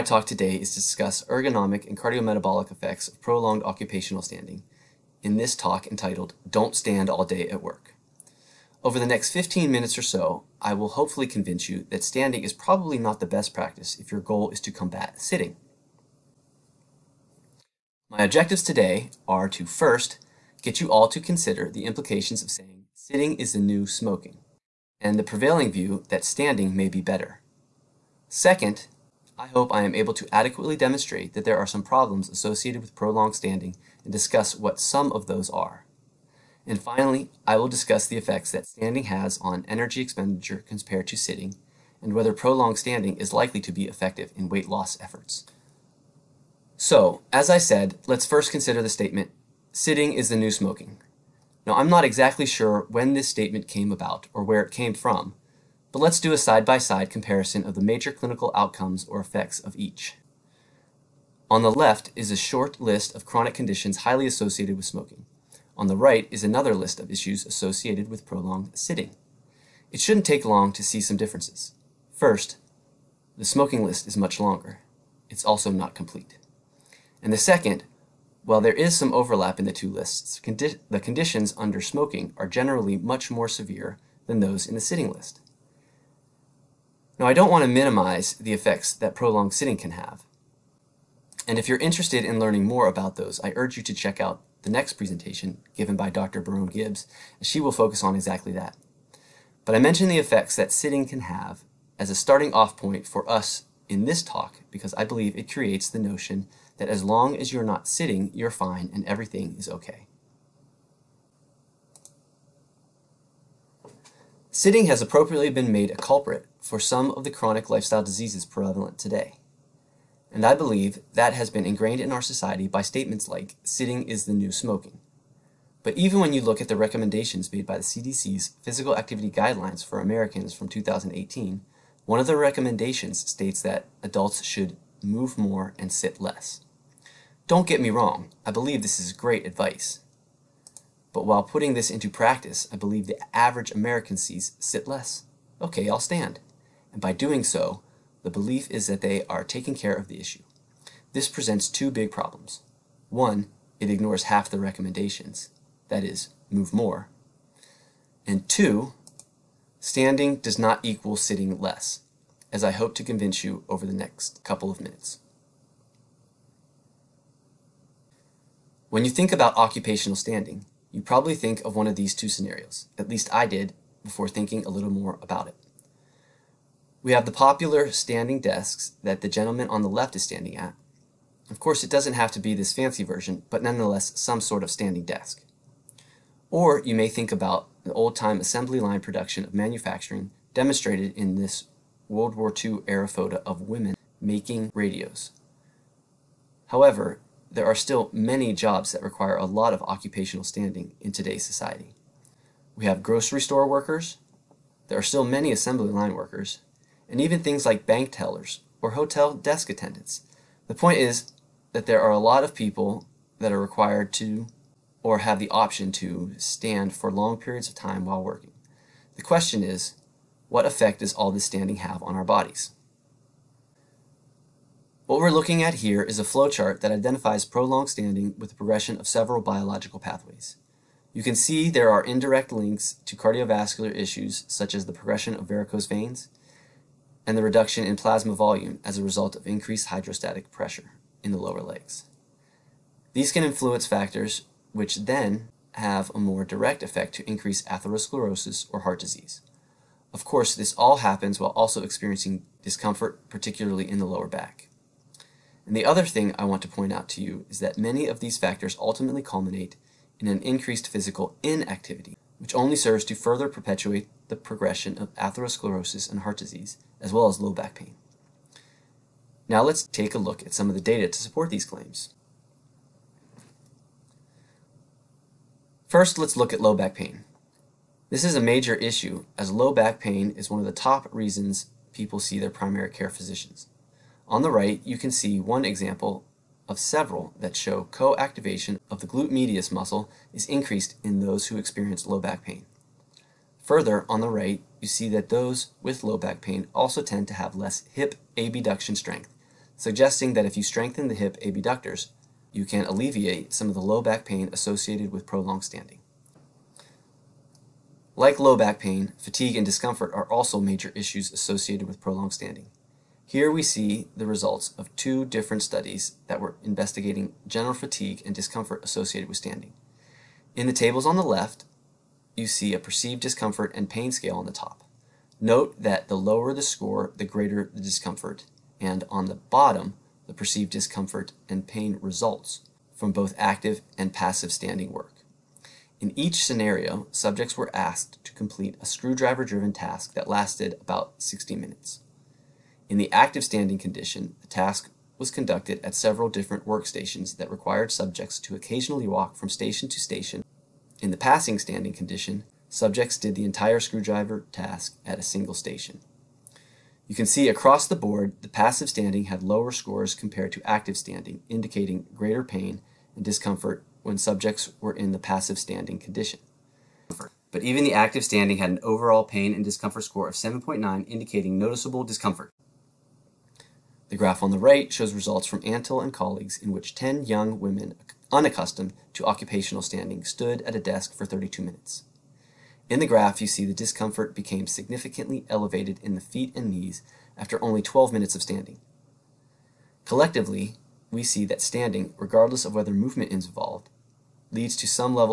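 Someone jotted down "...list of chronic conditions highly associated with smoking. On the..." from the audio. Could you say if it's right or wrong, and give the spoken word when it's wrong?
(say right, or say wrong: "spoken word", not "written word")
right.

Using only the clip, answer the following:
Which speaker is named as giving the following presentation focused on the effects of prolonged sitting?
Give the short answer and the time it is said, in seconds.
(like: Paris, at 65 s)
Dr. Barone Gibbs, at 96 s.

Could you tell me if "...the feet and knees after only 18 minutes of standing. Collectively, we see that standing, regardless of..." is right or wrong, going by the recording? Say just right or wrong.
wrong.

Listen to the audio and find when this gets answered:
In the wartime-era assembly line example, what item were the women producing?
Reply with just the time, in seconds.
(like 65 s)
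194 s.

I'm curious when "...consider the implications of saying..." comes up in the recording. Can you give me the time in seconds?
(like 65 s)
21 s.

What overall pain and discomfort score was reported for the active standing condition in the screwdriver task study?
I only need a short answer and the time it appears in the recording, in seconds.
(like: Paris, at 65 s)
7.9, at 370 s.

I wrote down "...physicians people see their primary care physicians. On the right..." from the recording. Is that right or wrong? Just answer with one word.
wrong.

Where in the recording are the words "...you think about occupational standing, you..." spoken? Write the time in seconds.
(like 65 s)
169 s.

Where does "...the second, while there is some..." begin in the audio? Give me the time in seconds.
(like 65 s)
77 s.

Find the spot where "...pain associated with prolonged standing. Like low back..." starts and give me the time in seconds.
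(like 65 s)
304 s.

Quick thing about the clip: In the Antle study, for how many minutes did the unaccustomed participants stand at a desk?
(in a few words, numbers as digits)
32 minutes.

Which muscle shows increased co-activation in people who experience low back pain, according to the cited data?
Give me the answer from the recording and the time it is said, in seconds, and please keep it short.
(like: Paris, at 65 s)
glute medius, at 289 s.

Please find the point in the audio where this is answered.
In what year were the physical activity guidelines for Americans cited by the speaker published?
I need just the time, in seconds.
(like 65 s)
130 s.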